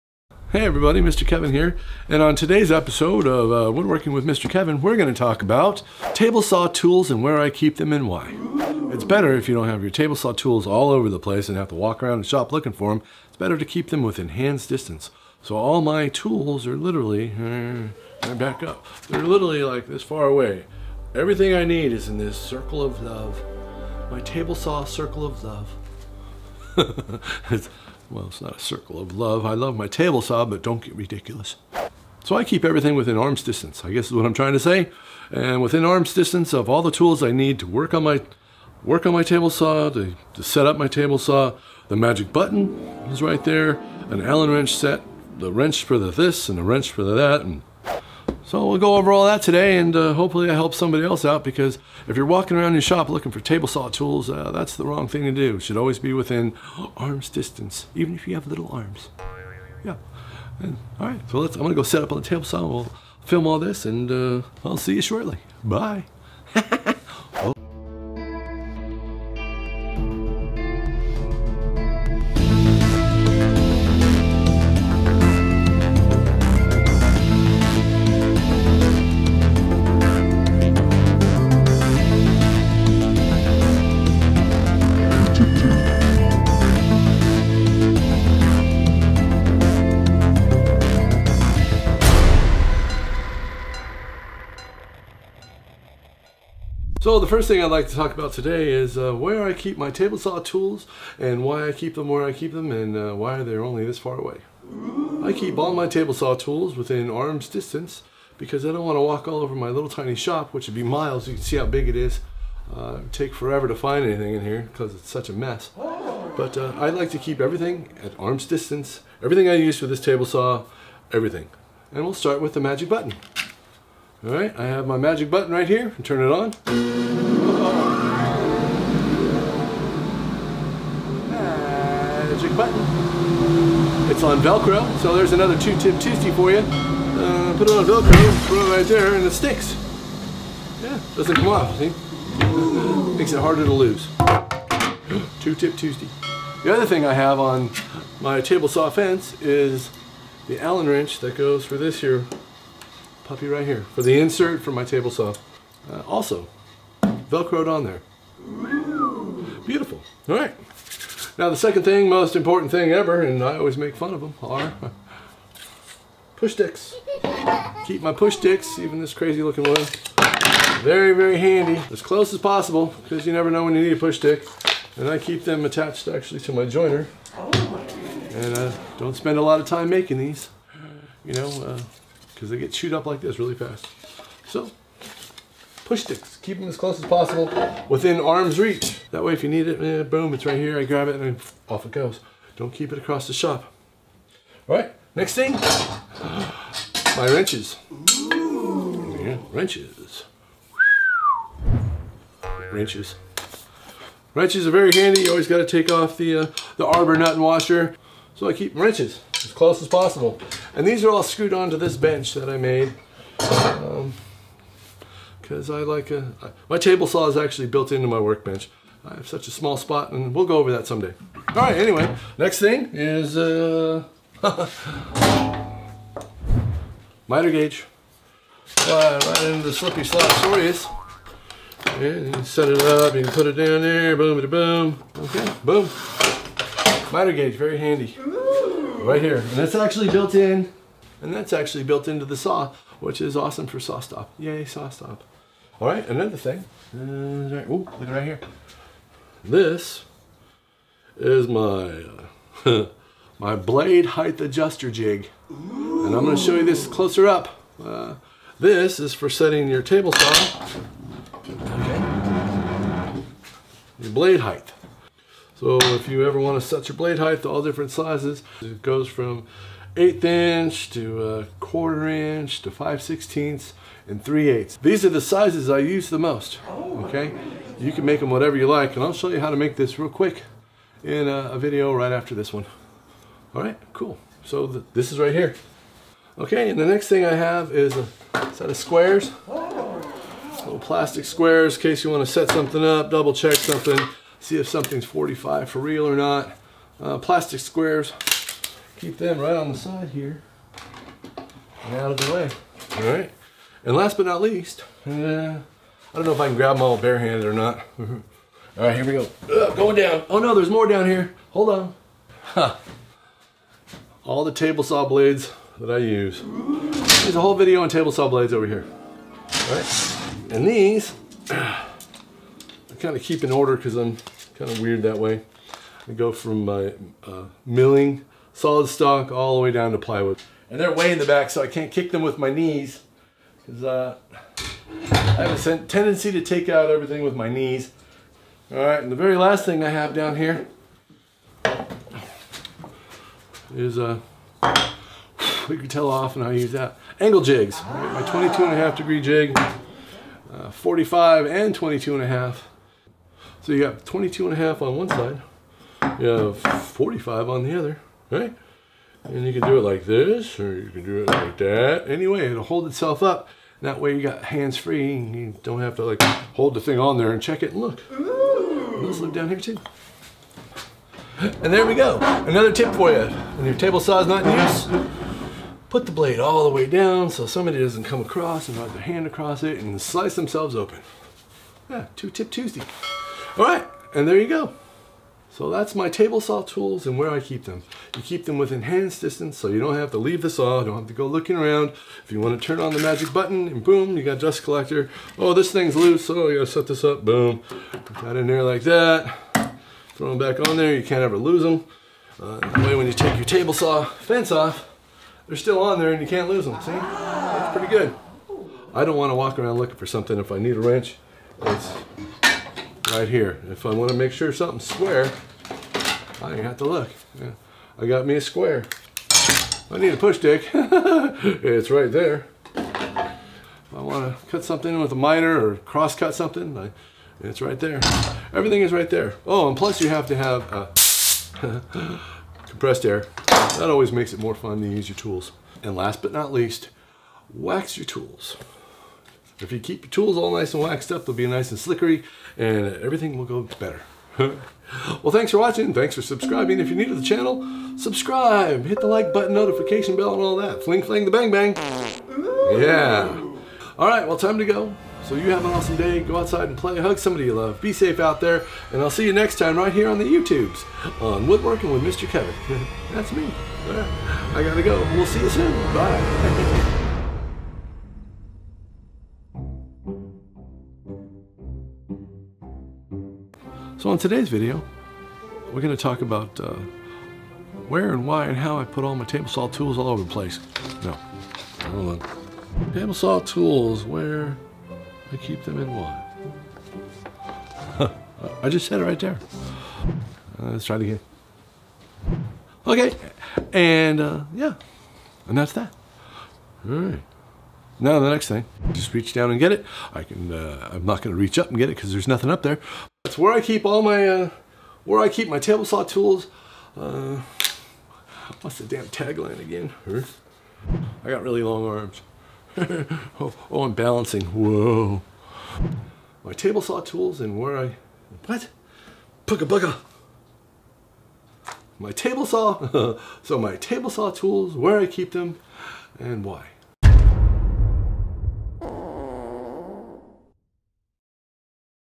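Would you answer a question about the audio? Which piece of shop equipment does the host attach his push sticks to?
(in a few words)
joiner.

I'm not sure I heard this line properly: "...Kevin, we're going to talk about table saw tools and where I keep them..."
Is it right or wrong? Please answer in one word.
right.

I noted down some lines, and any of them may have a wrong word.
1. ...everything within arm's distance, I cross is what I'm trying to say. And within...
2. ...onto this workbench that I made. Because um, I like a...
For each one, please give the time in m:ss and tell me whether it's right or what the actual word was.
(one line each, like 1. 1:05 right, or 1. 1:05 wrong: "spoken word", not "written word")
1. 0:32 wrong: "guess", not "cross"
2. 3:31 wrong: "bench", not "workbench".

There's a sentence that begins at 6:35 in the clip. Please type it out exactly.
Oh, this thing's loose, oh, you gotta set this up, boom.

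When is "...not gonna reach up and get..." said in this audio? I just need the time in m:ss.
8:21.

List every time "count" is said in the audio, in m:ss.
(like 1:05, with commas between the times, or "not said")
not said.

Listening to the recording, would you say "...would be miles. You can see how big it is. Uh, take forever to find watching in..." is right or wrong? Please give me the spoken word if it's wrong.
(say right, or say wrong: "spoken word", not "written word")
wrong: "anything", not "watching".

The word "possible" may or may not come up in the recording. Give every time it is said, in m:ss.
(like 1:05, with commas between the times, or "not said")
2:52, 3:07, 3:29.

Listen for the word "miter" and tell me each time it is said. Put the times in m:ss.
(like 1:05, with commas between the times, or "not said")
3:47, 3:57, 7:05.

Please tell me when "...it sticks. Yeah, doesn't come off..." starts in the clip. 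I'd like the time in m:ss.
2:19.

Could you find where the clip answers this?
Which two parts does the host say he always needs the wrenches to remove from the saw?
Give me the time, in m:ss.
3:26.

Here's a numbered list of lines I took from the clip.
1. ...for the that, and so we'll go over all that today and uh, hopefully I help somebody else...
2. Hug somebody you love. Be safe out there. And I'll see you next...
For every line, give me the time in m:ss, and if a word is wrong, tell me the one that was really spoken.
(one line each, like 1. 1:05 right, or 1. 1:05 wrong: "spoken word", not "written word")
1. 0:46 right
2. 7:36 right.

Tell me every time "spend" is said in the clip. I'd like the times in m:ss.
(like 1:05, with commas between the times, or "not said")
2:59.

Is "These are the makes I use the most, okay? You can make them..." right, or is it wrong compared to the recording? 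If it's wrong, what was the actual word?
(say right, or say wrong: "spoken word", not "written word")
wrong: "sizes", not "makes".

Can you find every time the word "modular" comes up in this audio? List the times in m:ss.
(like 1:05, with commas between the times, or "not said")
not said.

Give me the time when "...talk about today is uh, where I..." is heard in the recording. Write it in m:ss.
1:37.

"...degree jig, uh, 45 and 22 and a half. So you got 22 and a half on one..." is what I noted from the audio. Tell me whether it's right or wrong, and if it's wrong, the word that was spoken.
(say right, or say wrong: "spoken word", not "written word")
right.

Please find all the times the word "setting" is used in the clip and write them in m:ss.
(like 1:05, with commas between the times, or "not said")
4:19.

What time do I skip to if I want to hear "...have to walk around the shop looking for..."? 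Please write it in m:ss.
0:11.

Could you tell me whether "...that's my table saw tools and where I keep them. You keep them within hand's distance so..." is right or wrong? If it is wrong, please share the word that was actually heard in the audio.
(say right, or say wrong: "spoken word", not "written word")
right.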